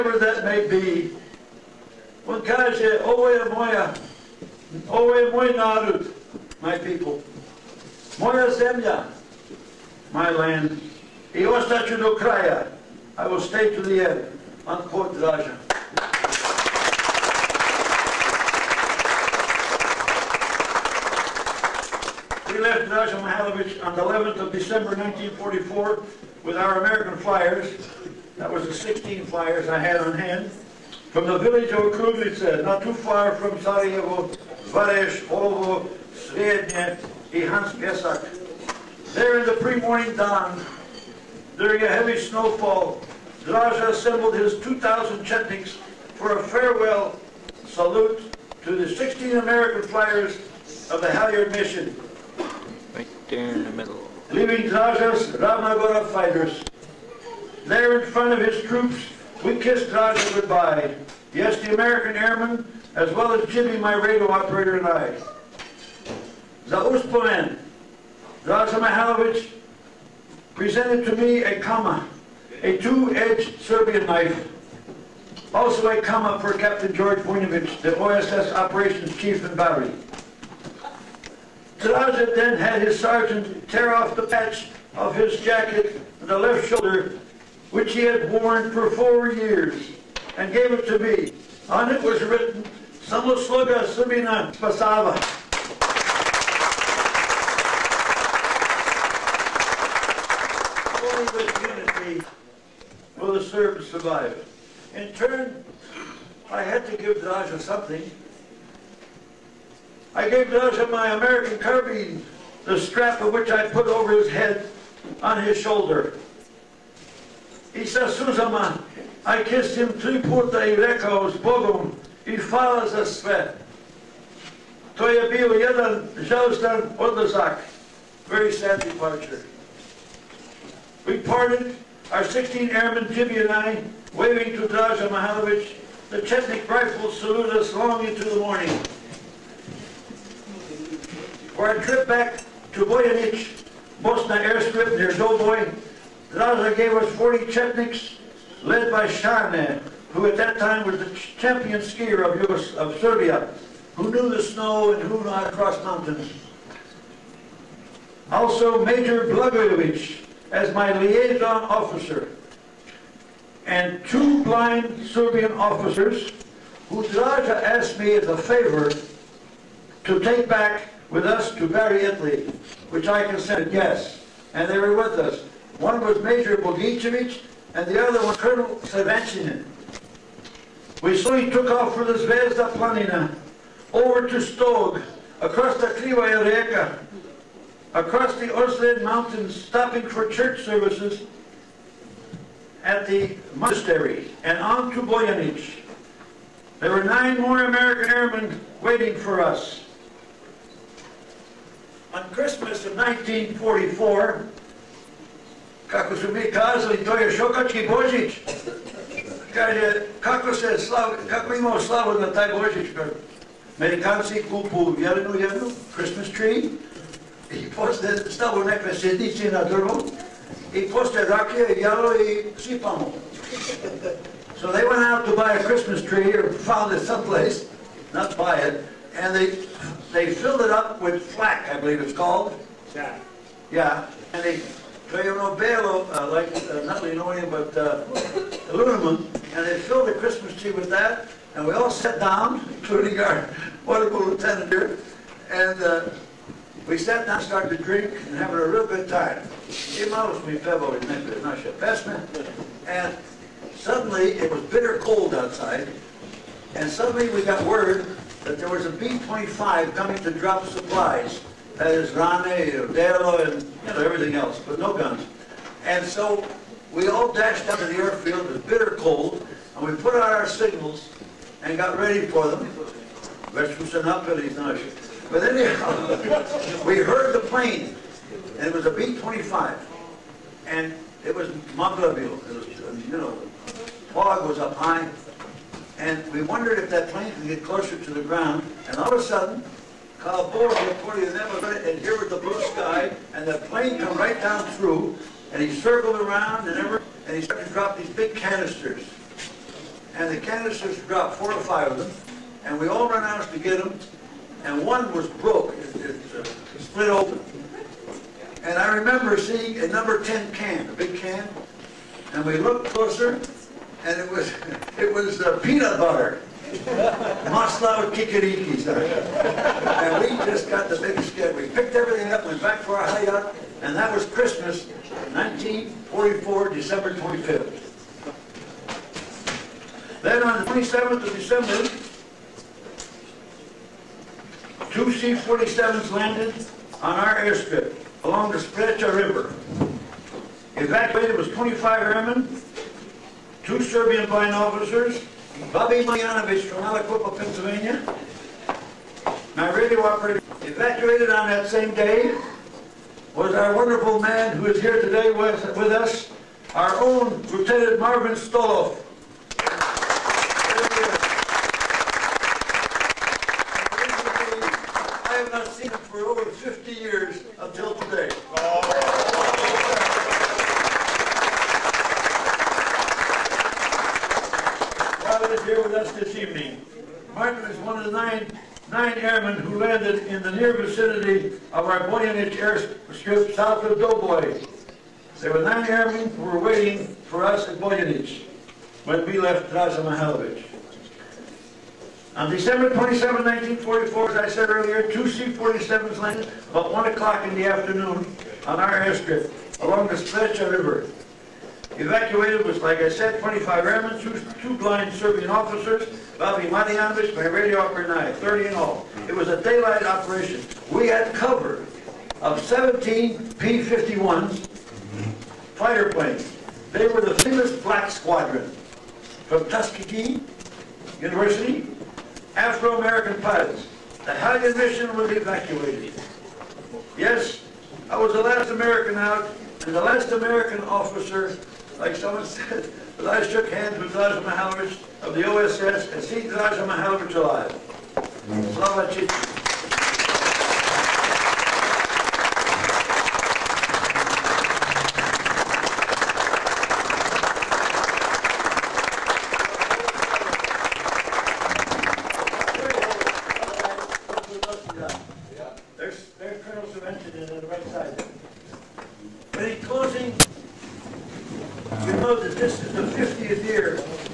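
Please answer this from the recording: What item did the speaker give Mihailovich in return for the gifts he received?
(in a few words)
American carbine.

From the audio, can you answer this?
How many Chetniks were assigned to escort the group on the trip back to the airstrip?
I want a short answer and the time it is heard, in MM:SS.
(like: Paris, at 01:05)
40, at 02:27.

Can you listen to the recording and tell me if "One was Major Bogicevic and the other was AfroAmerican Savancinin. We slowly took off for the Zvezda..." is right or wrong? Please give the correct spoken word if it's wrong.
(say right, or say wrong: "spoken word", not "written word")
wrong: "Colonel", not "AfroAmerican".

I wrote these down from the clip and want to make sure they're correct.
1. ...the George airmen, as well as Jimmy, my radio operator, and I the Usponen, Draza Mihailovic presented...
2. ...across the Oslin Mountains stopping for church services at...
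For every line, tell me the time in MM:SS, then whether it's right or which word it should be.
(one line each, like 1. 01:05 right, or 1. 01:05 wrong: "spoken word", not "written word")
1. 01:01 wrong: "American", not "George"
2. 03:07 right.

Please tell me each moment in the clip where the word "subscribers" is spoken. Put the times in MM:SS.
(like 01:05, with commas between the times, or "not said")
not said.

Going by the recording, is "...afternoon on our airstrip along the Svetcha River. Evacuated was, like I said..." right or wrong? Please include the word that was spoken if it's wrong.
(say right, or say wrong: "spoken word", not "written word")
right.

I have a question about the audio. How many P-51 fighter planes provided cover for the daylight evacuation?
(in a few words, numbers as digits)
17.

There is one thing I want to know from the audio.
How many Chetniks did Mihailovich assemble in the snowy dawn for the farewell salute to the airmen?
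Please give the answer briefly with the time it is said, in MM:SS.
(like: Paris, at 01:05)
2,000, at 00:44.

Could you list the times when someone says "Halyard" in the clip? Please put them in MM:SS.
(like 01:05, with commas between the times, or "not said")
00:51, 07:04.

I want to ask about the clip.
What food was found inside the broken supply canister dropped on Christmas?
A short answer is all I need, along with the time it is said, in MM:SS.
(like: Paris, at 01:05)
Peanut butter, at 05:15.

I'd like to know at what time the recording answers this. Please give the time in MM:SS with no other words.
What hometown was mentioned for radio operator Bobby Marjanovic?
05:46.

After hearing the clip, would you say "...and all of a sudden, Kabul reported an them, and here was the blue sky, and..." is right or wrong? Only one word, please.
right.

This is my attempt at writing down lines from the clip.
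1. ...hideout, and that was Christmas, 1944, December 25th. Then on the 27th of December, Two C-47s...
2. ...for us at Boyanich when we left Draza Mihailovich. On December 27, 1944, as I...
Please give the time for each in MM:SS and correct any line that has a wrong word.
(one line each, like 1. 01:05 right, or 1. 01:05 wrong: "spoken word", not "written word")
1. 05:23 right
2. 06:27 right.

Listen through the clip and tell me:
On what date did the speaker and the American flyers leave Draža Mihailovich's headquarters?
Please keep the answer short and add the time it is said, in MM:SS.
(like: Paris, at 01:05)
December 11, 1944, at 00:24.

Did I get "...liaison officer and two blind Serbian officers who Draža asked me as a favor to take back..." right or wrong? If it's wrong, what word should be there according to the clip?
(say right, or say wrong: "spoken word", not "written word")
right.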